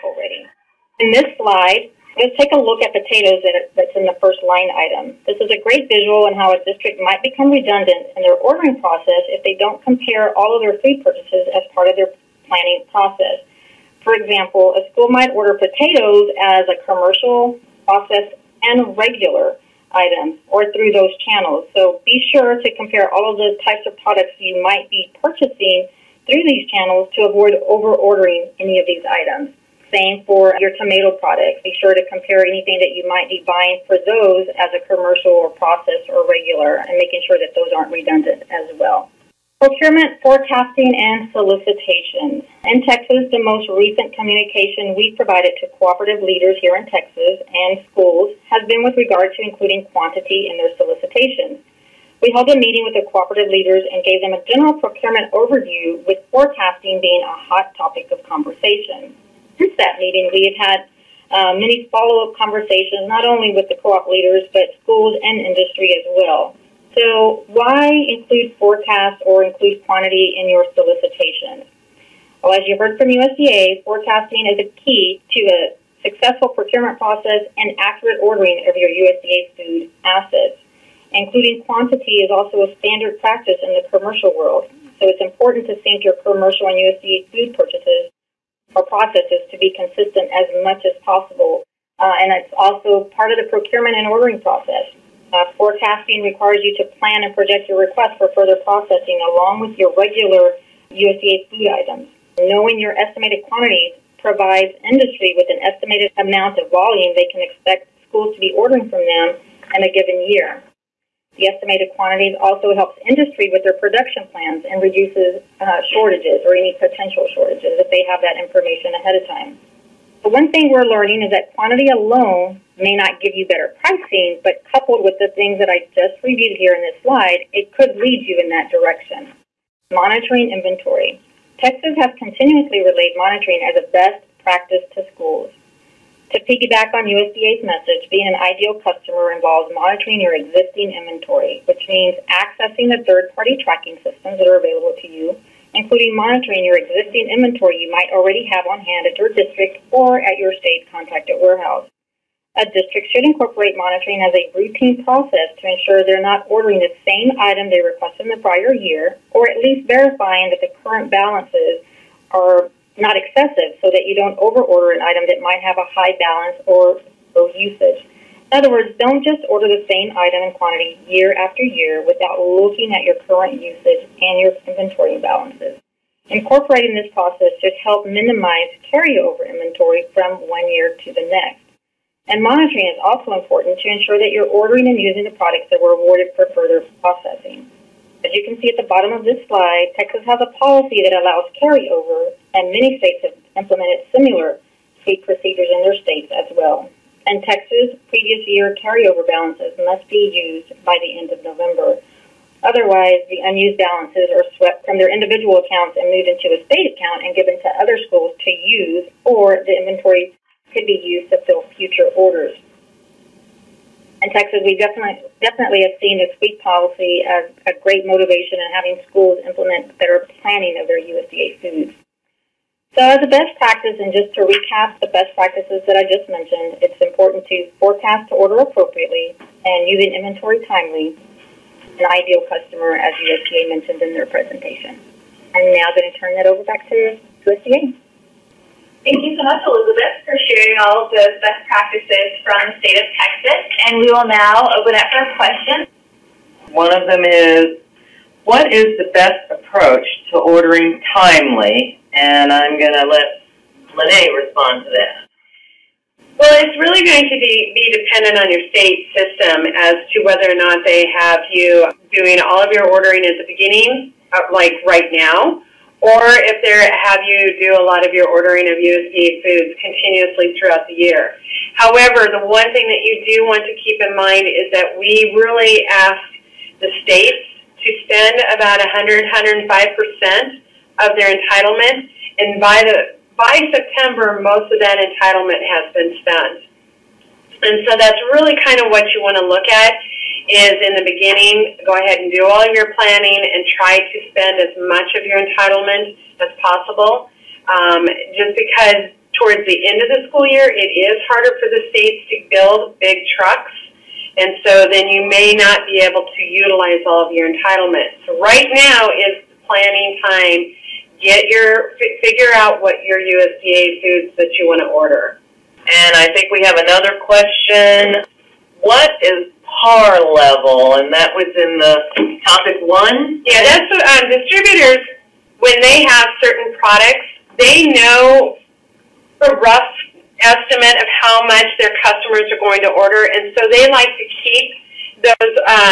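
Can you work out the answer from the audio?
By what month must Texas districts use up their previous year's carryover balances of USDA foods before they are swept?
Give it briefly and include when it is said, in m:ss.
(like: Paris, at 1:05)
November, at 3:21.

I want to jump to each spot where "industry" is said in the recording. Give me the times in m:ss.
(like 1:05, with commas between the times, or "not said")
1:05, 1:44, 1:53.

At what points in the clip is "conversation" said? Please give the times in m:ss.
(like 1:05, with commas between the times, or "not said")
0:58, 1:02.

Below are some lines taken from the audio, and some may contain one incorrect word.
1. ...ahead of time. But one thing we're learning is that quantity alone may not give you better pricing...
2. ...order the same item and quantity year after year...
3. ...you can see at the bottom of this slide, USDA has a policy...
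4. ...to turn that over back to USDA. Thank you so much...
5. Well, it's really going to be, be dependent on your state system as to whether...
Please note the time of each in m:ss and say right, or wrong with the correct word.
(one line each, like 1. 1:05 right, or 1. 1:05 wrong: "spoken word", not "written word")
1. 1:58 right
2. 2:49 right
3. 3:08 wrong: "Texas", not "USDA"
4. 3:56 right
5. 4:16 right.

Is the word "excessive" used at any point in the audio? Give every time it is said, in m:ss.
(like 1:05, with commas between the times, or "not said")
2:43.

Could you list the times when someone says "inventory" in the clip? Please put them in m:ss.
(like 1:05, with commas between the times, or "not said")
2:10, 2:20, 2:27, 2:54, 2:59, 3:29, 3:50.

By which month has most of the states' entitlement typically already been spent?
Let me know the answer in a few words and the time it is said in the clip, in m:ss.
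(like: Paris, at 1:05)
September, at 4:43.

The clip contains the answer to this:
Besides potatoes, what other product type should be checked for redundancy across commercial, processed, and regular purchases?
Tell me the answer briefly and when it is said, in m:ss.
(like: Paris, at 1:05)
Tomato products, at 0:30.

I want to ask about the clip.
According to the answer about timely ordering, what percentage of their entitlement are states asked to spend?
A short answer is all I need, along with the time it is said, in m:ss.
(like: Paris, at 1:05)
105%, at 4:39.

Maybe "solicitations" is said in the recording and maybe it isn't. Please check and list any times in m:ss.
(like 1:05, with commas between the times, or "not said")
0:41, 0:50, 1:10.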